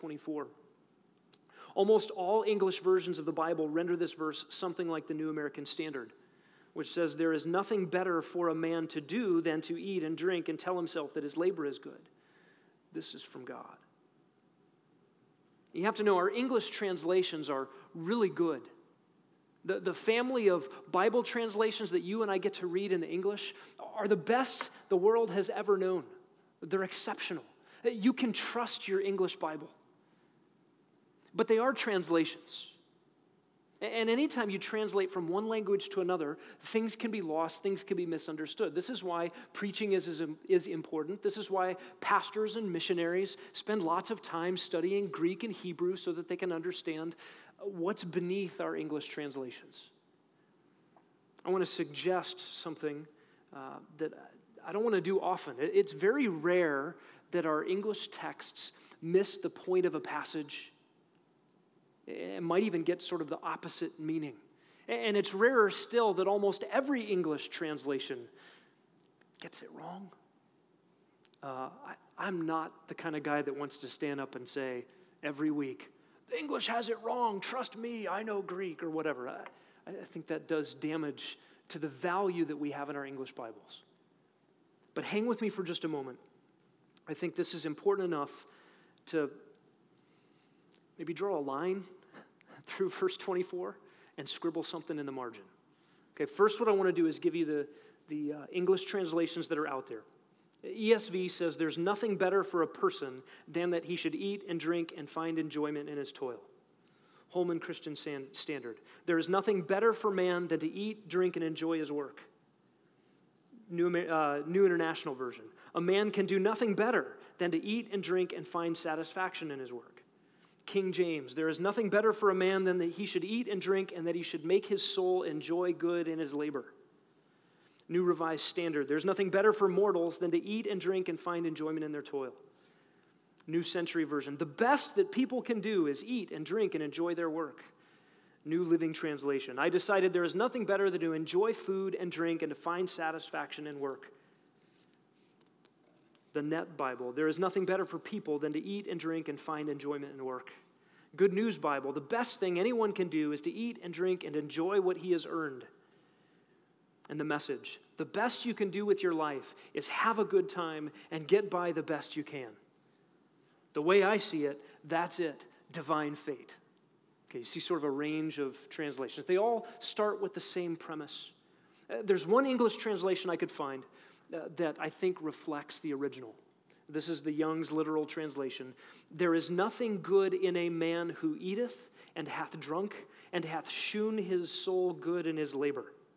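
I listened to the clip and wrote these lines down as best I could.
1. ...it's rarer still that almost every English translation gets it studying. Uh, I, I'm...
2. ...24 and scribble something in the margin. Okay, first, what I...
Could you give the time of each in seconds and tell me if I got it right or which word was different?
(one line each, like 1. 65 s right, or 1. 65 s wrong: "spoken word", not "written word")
1. 65 s wrong: "wrong", not "studying"
2. 93 s right.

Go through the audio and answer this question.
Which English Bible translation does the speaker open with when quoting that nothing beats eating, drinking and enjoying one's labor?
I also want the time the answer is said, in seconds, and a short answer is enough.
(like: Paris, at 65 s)
New American Standard, at 5 s.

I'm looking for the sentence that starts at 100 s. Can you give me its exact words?
ESV says there's nothing better for a person than that he should eat and drink and find enjoyment in his toil.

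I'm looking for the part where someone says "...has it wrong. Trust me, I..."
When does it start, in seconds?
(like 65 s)
76 s.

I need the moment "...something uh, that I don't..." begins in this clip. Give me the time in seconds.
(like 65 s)
52 s.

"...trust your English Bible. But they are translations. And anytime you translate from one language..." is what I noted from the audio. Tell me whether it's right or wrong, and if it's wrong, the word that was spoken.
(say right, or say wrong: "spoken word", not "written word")
right.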